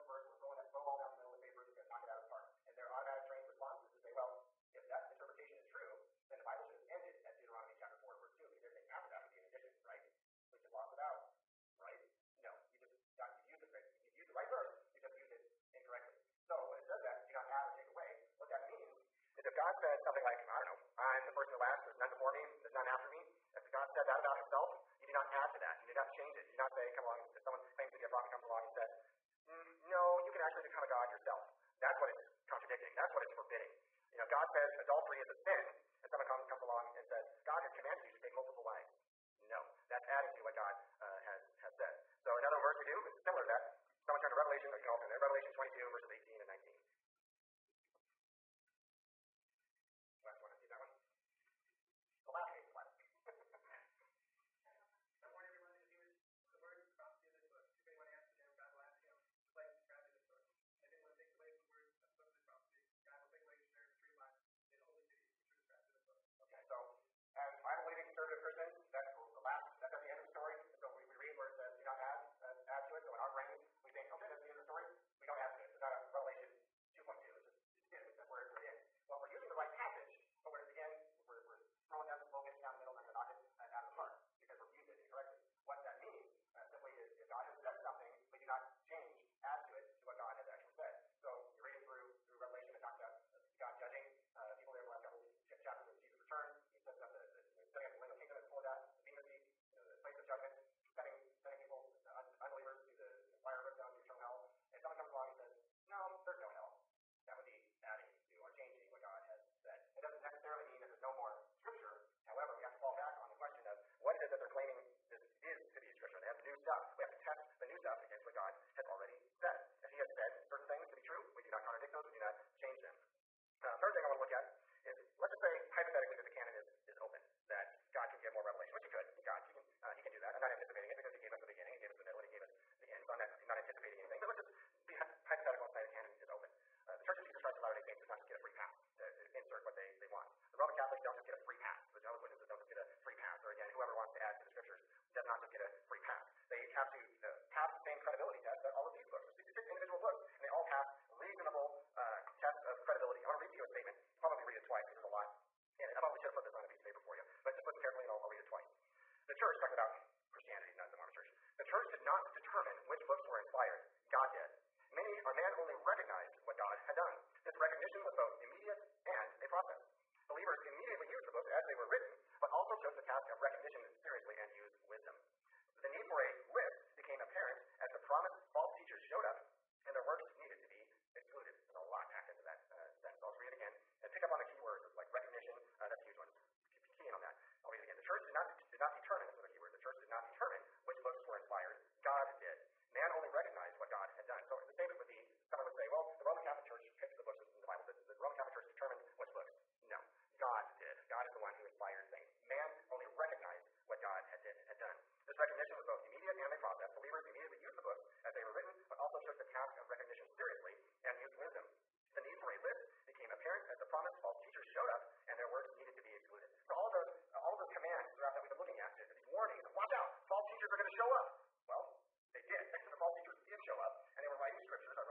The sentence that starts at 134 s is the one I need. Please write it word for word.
But let's just be hypothetical and say the canon is open.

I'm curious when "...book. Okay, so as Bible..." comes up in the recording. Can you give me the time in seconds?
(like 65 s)
66 s.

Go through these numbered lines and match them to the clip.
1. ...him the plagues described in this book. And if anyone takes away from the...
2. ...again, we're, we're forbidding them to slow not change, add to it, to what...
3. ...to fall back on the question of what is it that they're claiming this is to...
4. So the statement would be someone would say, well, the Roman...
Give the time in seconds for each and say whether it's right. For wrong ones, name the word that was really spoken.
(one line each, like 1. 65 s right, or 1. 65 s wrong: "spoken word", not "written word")
1. 59 s right
2. 80 s wrong: "throwing", not "forbidding"
3. 112 s right
4. 194 s right.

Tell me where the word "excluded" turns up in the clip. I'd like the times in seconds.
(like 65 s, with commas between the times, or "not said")
181 s, 216 s.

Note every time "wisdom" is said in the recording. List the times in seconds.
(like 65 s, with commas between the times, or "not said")
174 s, 211 s.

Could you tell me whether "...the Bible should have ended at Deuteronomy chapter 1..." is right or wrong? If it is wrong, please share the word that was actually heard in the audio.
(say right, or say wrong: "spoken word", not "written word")
wrong: "4", not "1".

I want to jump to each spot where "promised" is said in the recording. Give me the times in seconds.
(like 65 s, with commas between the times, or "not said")
178 s, 213 s.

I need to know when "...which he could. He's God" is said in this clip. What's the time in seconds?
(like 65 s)
128 s.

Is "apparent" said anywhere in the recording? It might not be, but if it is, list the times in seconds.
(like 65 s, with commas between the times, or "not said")
177 s, 213 s.